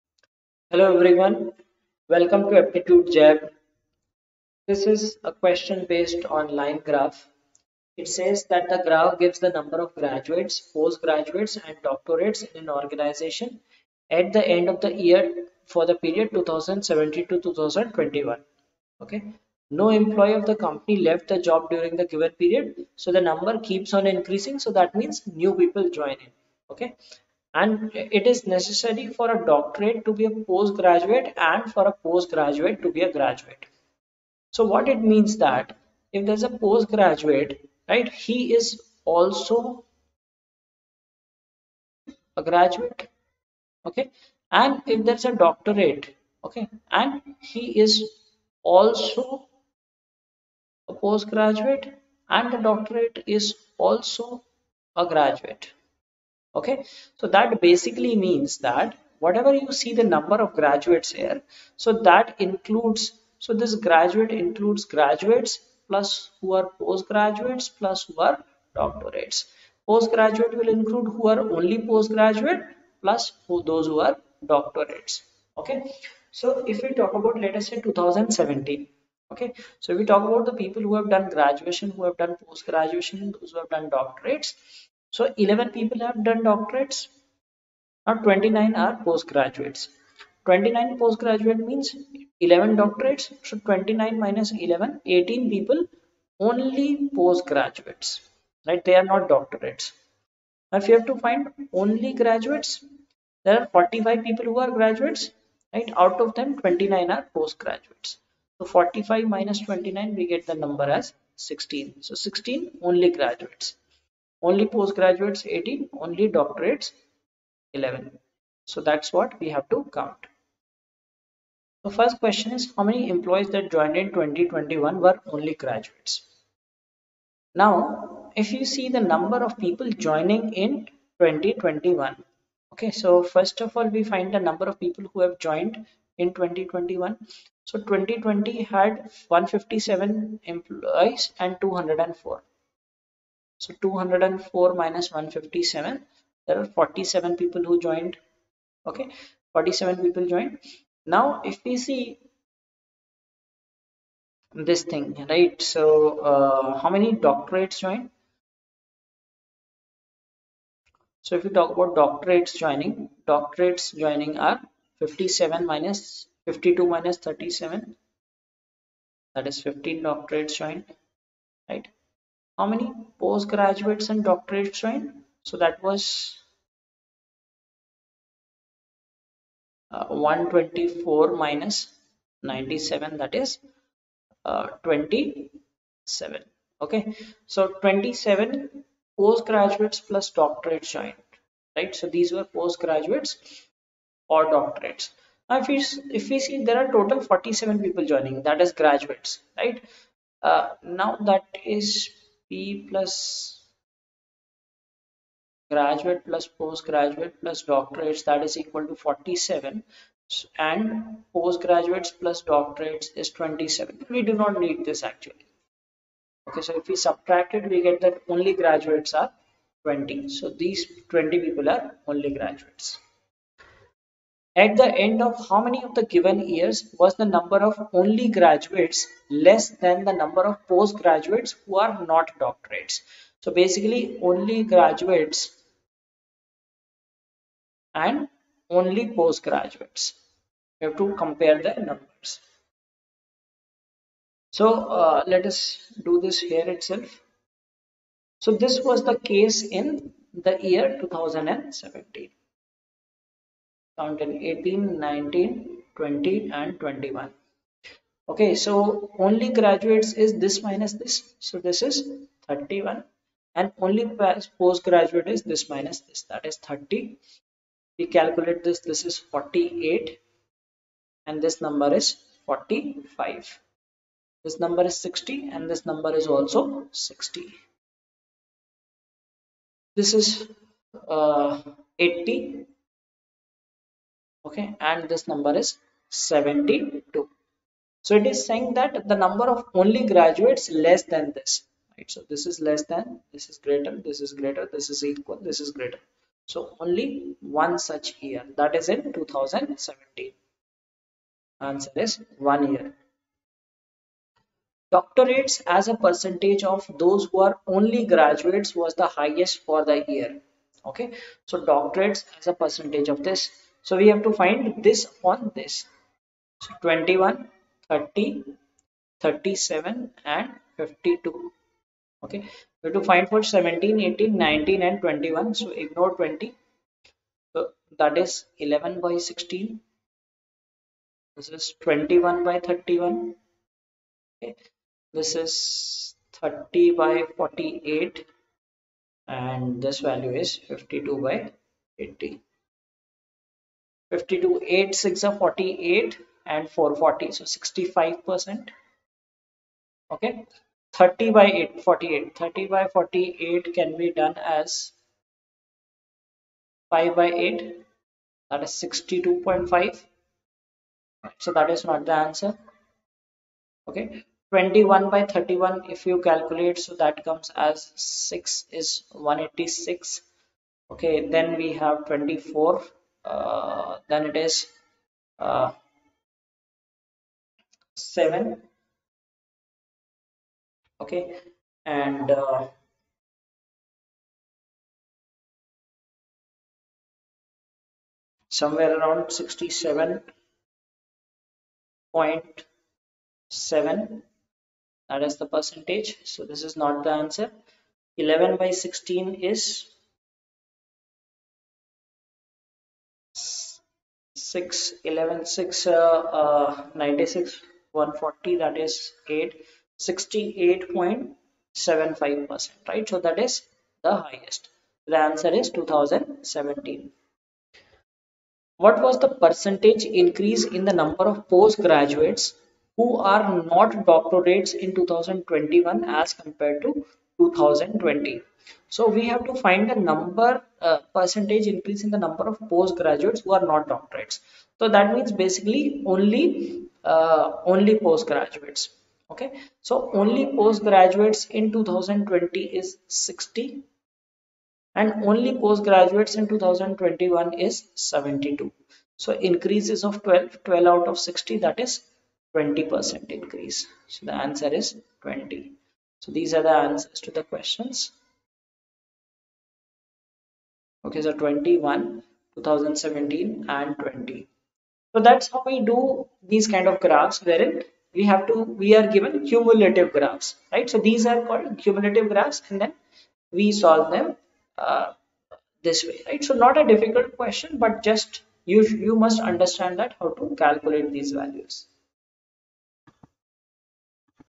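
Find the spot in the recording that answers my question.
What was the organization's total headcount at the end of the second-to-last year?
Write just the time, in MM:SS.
02:17.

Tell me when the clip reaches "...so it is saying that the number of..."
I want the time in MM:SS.
04:48.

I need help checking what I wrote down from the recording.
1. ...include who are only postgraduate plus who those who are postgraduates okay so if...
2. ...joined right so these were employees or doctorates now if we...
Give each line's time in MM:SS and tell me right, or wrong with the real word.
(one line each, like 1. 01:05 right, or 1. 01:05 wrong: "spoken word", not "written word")
1. 01:10 wrong: "doctorates", not "postgraduates"
2. 03:10 wrong: "postgraduates", not "employees".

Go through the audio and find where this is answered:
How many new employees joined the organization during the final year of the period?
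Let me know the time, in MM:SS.
02:29.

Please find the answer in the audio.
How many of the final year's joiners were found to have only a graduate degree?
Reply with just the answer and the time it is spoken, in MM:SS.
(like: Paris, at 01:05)
20, at 03:38.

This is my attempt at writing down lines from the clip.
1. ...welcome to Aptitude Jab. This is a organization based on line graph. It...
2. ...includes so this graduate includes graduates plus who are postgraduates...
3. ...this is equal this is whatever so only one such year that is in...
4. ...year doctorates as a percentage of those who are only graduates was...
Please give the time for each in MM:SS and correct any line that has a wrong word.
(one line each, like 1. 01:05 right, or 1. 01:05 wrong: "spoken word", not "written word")
1. 00:02 wrong: "question", not "organization"
2. 01:02 right
3. 04:54 wrong: "greater", not "whatever"
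4. 05:02 right.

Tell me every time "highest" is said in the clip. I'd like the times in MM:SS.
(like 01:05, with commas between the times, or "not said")
05:09, 06:54.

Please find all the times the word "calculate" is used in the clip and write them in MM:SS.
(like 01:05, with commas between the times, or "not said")
04:28, 06:06, 08:00.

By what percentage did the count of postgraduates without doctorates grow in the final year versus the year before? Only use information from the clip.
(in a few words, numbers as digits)
20%.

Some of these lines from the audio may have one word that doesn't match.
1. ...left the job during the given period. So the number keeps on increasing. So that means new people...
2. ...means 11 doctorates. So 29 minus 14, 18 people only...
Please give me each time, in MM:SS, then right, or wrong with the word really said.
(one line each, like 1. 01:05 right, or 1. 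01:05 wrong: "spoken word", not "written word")
1. 00:21 right
2. 01:31 wrong: "11", not "14".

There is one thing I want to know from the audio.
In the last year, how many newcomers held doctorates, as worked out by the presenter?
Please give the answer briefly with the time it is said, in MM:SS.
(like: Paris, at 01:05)
15, at 02:49.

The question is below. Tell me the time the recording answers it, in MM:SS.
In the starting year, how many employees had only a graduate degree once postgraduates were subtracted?
01:50.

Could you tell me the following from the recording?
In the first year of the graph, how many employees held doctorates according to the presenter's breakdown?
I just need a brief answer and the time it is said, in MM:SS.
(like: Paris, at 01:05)
11, at 01:25.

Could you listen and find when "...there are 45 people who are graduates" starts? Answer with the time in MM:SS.
01:43.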